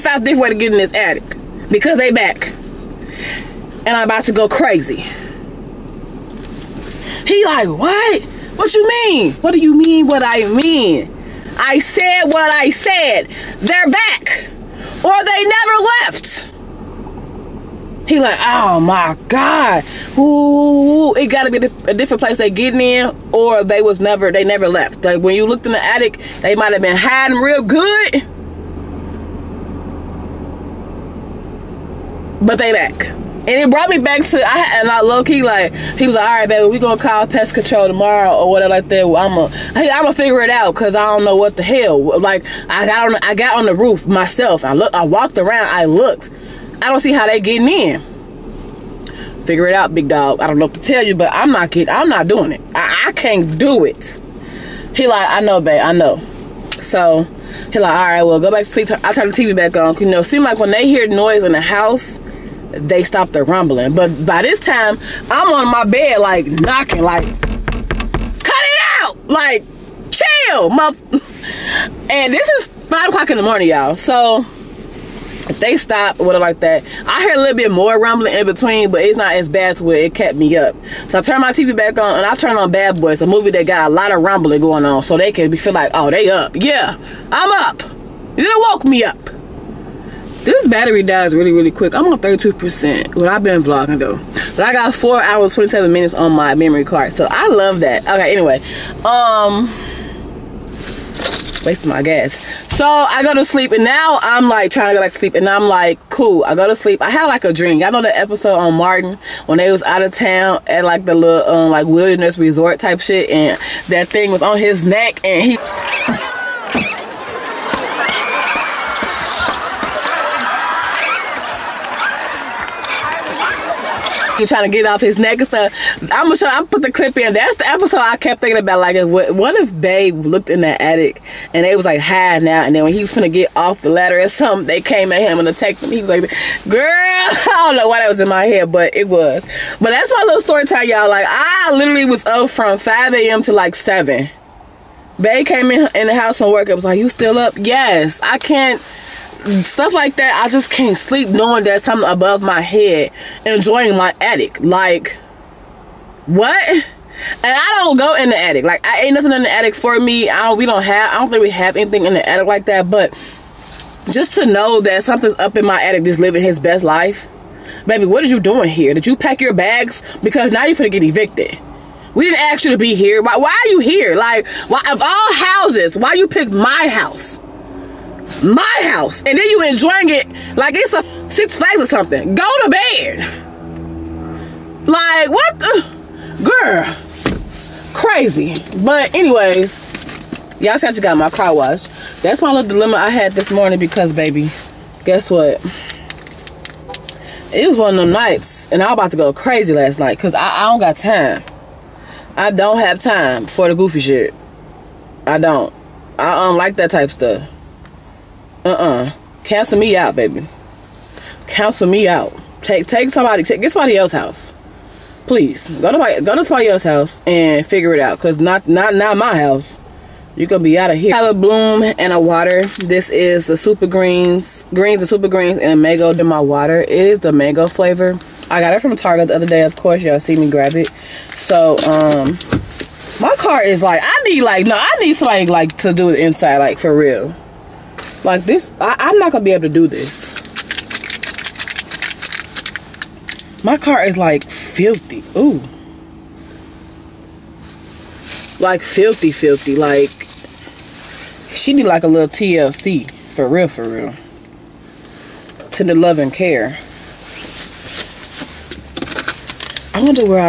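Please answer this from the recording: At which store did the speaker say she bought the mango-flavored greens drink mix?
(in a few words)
Target.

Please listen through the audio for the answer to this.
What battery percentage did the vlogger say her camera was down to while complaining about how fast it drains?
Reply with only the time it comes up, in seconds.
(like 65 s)
92 s.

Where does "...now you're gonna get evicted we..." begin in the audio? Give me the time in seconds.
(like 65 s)
170 s.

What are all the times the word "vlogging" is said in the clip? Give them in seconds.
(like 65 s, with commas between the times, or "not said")
93 s.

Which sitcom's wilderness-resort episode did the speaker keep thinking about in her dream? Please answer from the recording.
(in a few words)
Martin.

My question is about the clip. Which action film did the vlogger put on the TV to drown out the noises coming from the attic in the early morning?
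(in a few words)
Bad Boys.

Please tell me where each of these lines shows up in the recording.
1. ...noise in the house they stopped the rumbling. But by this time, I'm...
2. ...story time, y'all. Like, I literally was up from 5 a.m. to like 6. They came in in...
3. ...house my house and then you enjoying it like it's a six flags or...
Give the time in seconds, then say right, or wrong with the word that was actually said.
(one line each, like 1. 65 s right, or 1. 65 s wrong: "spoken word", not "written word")
1. 61 s right
2. 140 s wrong: "7", not "6"
3. 176 s right.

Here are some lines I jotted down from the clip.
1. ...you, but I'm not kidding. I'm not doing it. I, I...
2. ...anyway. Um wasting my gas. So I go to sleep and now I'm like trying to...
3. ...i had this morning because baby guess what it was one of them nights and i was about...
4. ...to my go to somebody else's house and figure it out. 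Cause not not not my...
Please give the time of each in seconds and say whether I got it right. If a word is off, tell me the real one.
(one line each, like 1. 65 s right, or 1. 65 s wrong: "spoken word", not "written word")
1. 51 s right
2. 98 s right
3. 192 s right
4. 215 s right.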